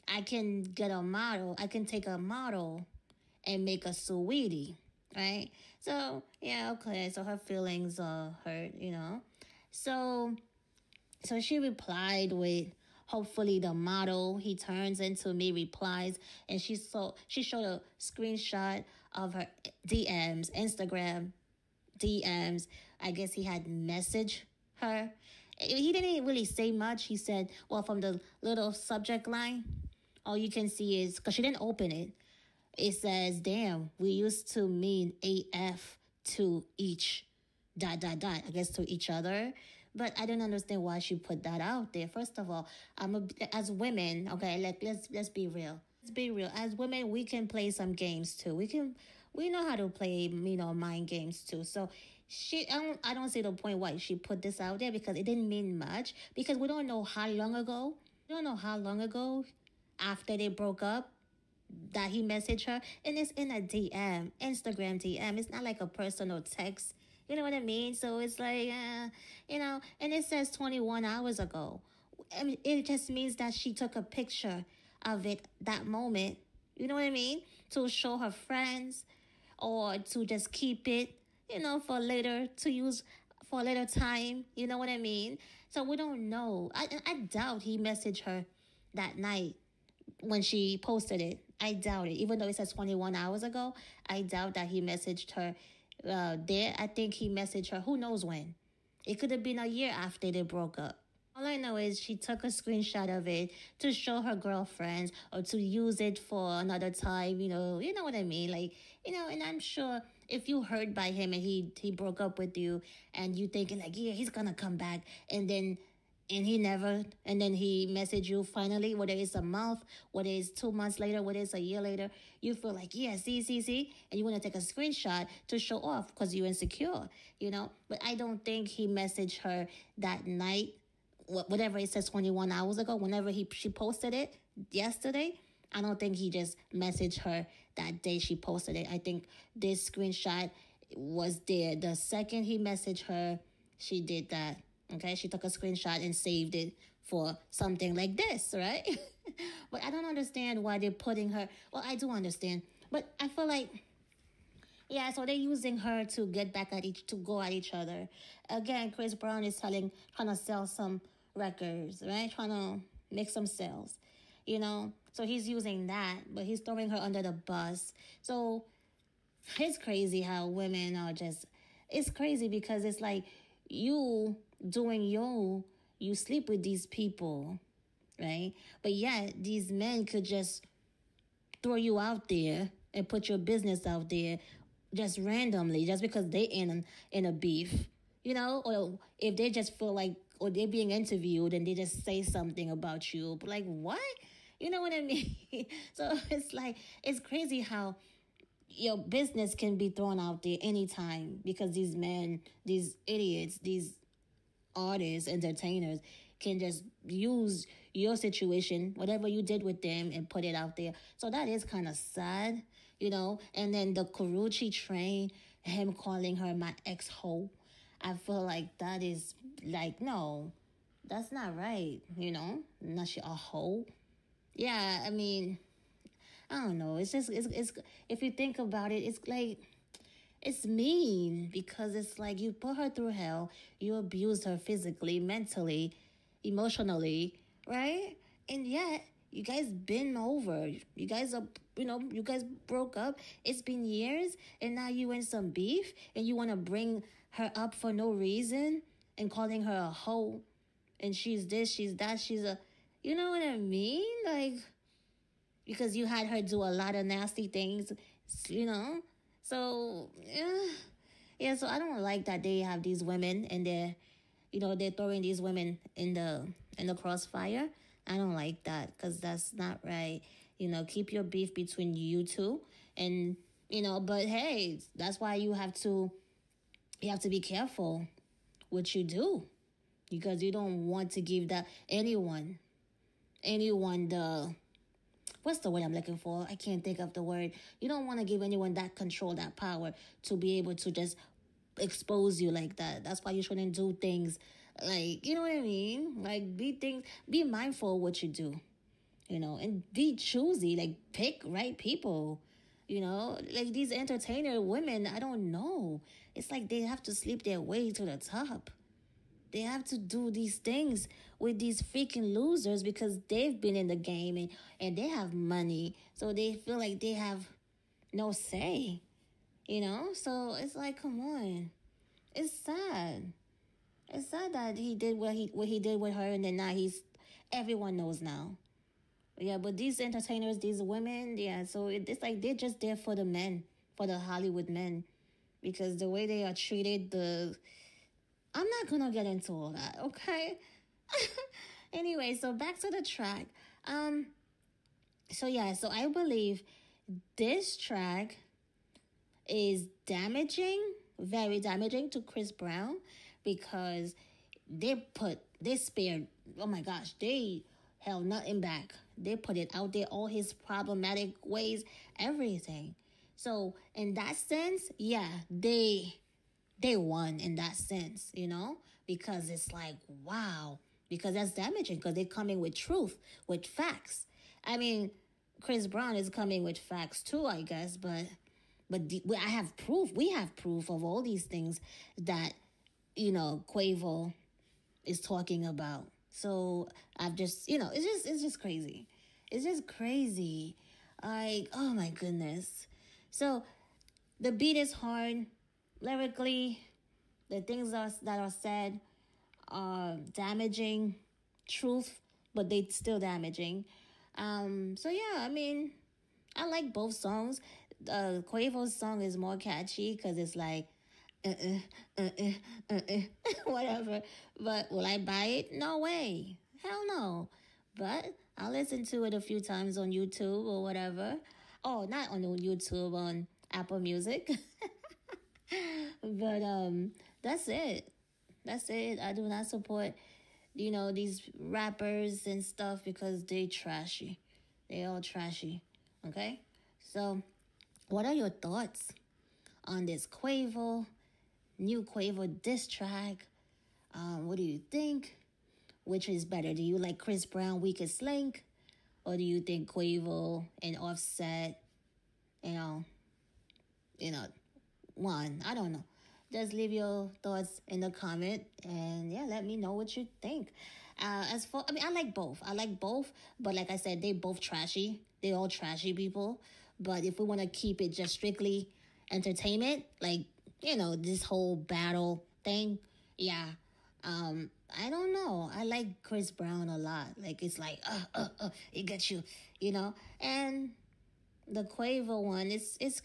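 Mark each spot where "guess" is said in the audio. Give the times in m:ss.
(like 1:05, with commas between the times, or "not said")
0:23, 0:38, 6:17.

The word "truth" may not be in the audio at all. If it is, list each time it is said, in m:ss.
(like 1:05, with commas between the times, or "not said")
6:12, 6:41.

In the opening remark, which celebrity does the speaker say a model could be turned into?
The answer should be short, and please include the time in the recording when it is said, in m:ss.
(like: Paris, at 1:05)
Saweetie, at 0:03.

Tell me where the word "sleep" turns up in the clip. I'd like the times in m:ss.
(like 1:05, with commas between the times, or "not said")
2:56, 5:07.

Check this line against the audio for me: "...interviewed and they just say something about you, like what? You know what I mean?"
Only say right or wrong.
right.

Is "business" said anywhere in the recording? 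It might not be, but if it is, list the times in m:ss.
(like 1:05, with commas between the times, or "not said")
3:03, 3:18.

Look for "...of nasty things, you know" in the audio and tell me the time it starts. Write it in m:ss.
4:16.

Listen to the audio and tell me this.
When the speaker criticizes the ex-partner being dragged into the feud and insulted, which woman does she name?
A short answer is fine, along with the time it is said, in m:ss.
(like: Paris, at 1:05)
Karrueche, at 3:34.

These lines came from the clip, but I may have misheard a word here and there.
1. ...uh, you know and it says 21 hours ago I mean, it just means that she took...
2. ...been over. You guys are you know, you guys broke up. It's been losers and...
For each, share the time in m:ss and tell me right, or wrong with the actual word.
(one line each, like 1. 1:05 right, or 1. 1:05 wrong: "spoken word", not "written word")
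1. 1:08 right
2. 3:59 wrong: "years", not "losers".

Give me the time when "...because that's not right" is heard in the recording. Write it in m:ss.
4:28.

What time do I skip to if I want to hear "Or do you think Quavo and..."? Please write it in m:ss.
7:29.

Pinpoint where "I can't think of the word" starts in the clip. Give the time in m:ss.
4:46.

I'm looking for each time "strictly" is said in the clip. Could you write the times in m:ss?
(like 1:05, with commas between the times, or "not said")
7:48.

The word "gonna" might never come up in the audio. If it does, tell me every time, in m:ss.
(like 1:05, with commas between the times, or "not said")
1:54, 5:38.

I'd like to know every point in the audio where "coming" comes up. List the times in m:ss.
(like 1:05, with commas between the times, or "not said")
6:12, 6:16.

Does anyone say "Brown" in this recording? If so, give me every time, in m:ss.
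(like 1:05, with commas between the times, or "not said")
2:39, 5:52, 6:15, 7:27, 7:56.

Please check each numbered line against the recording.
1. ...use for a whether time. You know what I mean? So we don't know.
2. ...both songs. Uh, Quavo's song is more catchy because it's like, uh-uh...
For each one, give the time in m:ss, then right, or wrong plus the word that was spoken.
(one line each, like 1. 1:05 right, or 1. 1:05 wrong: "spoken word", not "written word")
1. 1:22 wrong: "later", not "whether"
2. 6:46 right.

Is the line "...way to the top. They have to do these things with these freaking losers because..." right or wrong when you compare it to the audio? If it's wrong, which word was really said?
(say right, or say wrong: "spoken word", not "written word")
right.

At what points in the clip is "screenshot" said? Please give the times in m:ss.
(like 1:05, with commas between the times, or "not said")
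0:17, 1:42, 2:04, 2:19, 2:25.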